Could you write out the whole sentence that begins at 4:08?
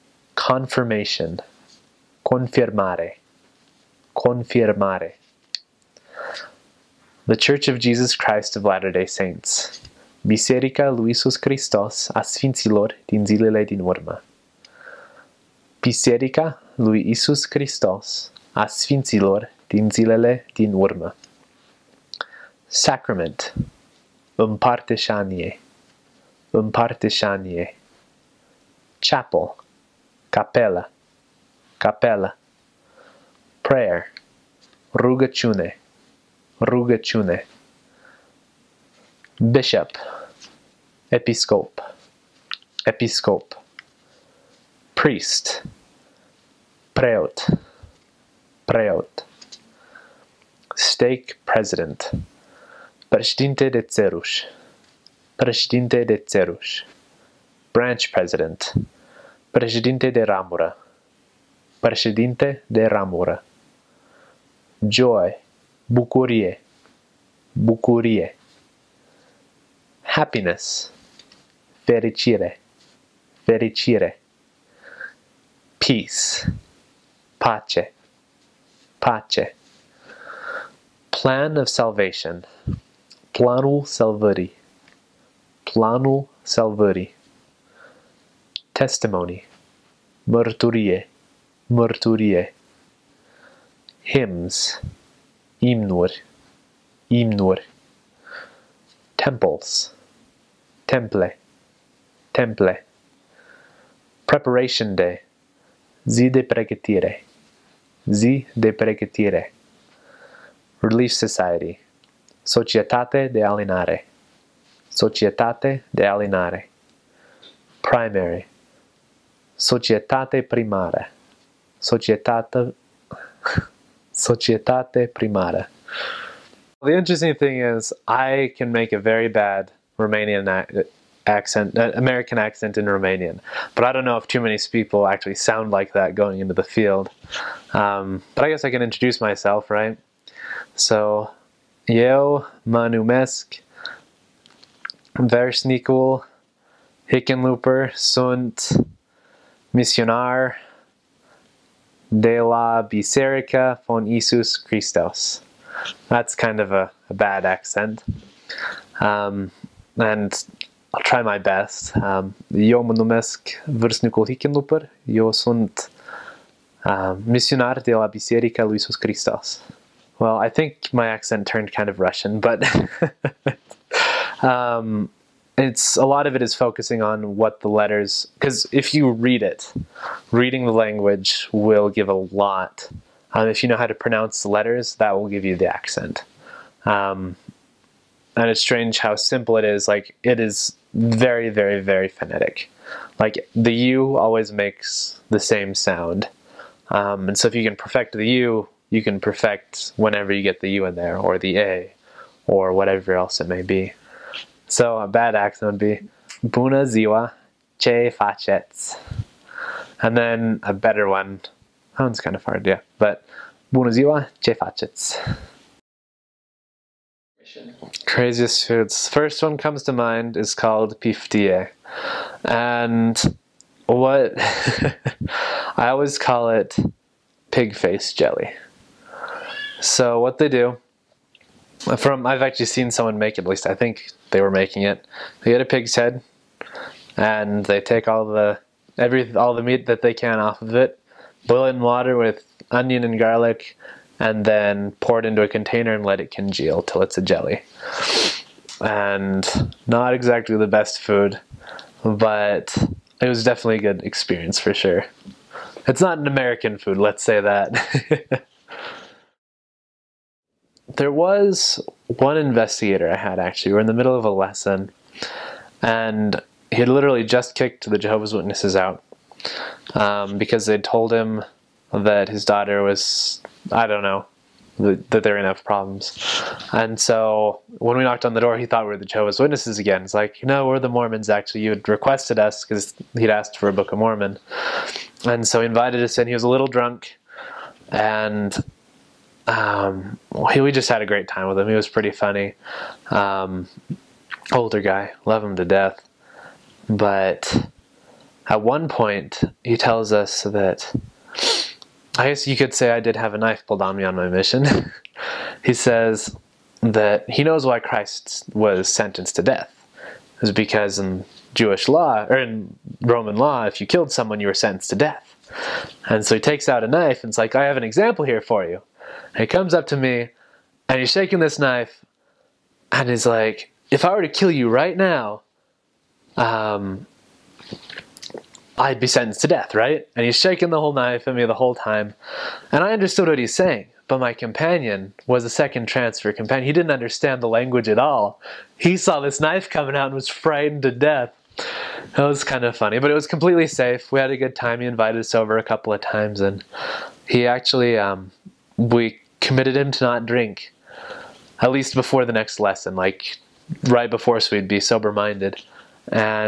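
And not exactly the best food, but it was definitely a good experience for sure.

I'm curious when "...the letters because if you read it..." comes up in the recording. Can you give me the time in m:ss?
2:57.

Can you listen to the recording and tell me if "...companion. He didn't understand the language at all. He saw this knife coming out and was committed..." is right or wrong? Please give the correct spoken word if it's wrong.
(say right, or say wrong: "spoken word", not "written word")
wrong: "frightened", not "committed".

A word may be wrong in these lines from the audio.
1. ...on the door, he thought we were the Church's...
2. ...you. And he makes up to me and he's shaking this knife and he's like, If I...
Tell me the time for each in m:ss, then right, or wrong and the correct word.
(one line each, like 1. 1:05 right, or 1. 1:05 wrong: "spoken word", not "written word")
1. 4:38 wrong: "Jehovah", not "Church"
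2. 5:18 wrong: "comes", not "makes".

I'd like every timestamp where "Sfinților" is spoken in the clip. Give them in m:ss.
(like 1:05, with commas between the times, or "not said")
0:12, 0:18.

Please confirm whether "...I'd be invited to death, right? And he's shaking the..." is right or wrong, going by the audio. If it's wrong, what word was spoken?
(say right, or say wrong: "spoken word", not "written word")
wrong: "sentenced", not "invited".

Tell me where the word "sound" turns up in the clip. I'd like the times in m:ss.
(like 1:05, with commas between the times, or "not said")
2:15, 3:15.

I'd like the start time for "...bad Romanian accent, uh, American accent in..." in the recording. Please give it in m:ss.
2:09.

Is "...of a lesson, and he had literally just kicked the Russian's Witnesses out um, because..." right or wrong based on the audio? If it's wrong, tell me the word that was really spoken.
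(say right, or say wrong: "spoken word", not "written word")
wrong: "Jehovah", not "Russian".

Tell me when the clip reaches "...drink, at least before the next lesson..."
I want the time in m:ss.
5:50.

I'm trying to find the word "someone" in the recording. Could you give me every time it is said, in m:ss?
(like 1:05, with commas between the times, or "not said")
3:52, 5:14.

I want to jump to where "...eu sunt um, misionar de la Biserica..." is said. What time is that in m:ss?
2:45.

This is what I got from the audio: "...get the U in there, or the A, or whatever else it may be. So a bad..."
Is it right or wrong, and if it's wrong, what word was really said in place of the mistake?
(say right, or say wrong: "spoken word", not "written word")
right.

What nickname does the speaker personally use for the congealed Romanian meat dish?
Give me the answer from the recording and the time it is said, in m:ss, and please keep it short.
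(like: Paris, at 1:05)
pig face jelly, at 3:47.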